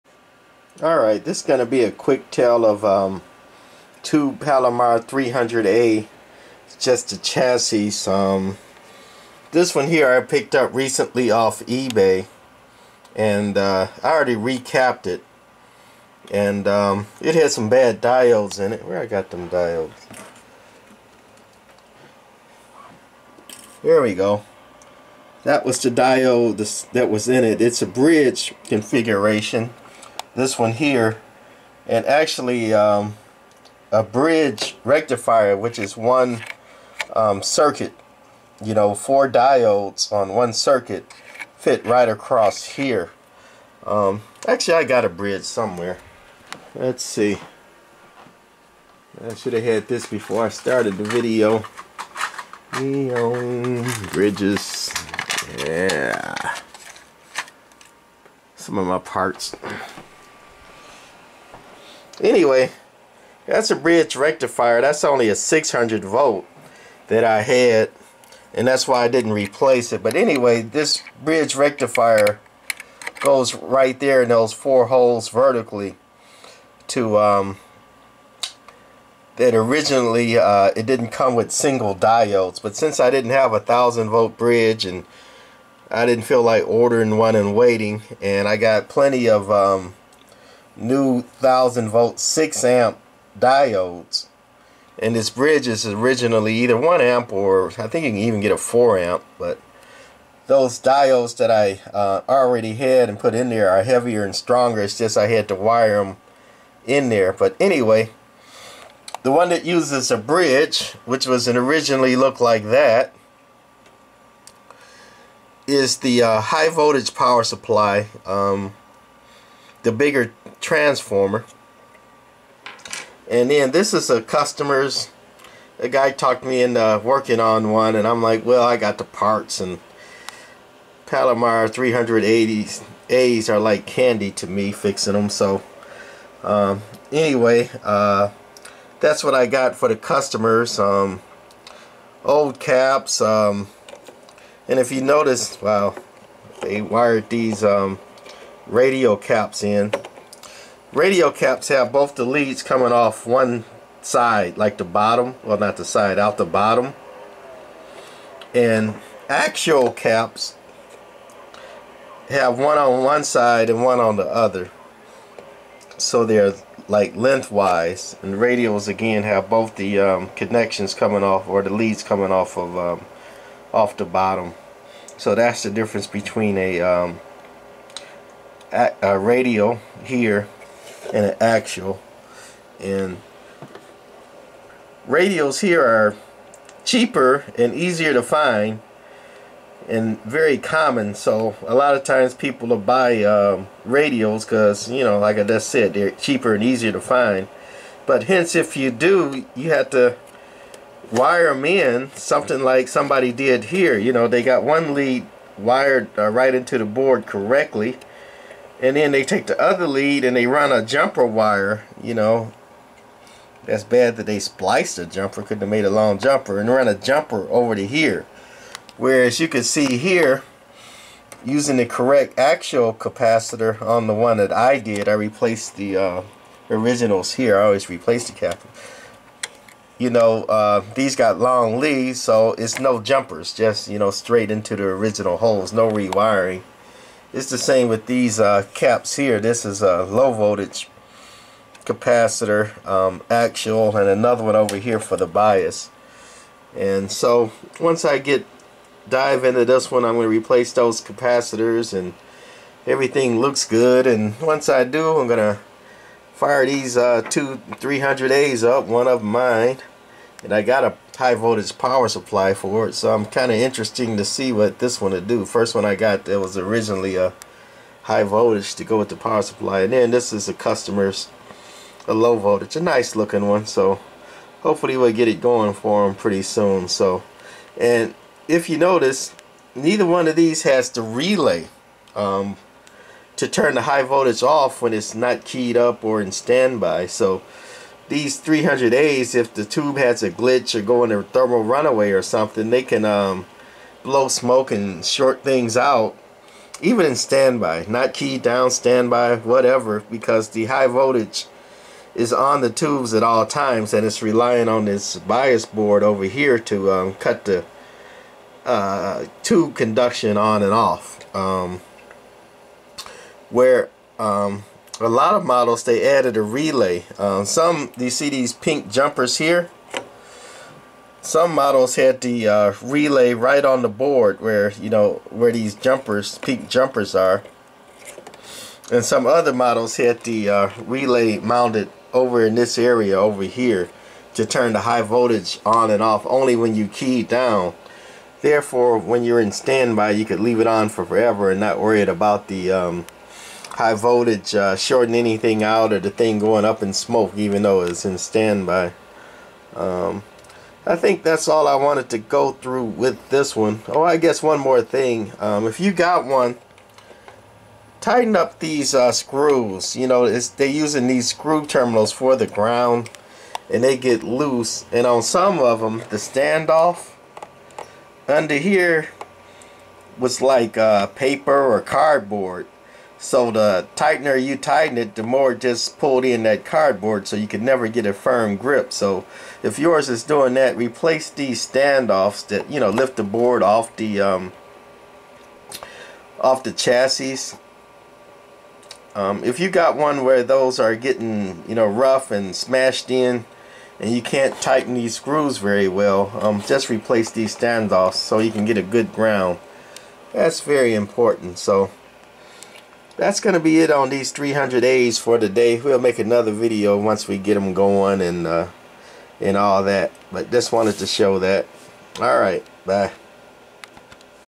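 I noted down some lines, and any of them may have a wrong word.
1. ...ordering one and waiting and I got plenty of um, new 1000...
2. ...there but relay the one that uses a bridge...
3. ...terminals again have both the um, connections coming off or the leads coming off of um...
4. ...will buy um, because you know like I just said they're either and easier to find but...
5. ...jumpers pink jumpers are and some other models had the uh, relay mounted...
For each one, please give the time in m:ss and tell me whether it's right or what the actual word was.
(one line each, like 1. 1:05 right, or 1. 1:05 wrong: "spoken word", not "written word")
1. 1:26 right
2. 1:47 wrong: "anyway", not "relay"
3. 2:48 wrong: "radials", not "terminals"
4. 3:12 wrong: "cheaper", not "either"
5. 5:25 right.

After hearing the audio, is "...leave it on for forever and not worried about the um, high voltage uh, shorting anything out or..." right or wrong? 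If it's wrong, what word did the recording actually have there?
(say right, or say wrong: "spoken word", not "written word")
right.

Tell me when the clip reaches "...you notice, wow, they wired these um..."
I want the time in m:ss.
2:24.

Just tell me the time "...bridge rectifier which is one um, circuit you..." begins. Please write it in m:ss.
0:34.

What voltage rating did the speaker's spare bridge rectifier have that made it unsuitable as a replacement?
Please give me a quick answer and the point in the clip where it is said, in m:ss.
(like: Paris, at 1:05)
600 volt, at 1:05.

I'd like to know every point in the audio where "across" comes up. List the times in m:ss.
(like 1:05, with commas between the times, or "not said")
0:42.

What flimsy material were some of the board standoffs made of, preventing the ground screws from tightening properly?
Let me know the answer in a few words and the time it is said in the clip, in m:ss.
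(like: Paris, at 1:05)
paper or cardboard, at 6:11.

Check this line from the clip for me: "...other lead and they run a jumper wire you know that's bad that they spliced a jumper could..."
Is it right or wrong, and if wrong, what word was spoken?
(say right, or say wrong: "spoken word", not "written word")
right.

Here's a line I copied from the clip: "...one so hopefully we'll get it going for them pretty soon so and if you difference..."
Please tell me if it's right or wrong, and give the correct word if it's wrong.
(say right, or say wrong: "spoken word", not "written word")
wrong: "notice", not "difference".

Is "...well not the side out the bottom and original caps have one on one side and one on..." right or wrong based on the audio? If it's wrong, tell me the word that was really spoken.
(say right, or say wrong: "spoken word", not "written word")
wrong: "axial", not "original".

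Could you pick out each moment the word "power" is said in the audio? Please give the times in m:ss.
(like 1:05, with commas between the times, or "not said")
1:57, 4:21, 4:29.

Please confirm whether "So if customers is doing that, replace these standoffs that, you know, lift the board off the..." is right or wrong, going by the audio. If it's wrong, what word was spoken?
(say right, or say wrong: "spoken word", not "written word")
wrong: "yours", not "customers".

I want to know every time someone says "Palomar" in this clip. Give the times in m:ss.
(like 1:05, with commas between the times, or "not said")
0:04, 2:11.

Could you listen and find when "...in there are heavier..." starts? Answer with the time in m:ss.
1:43.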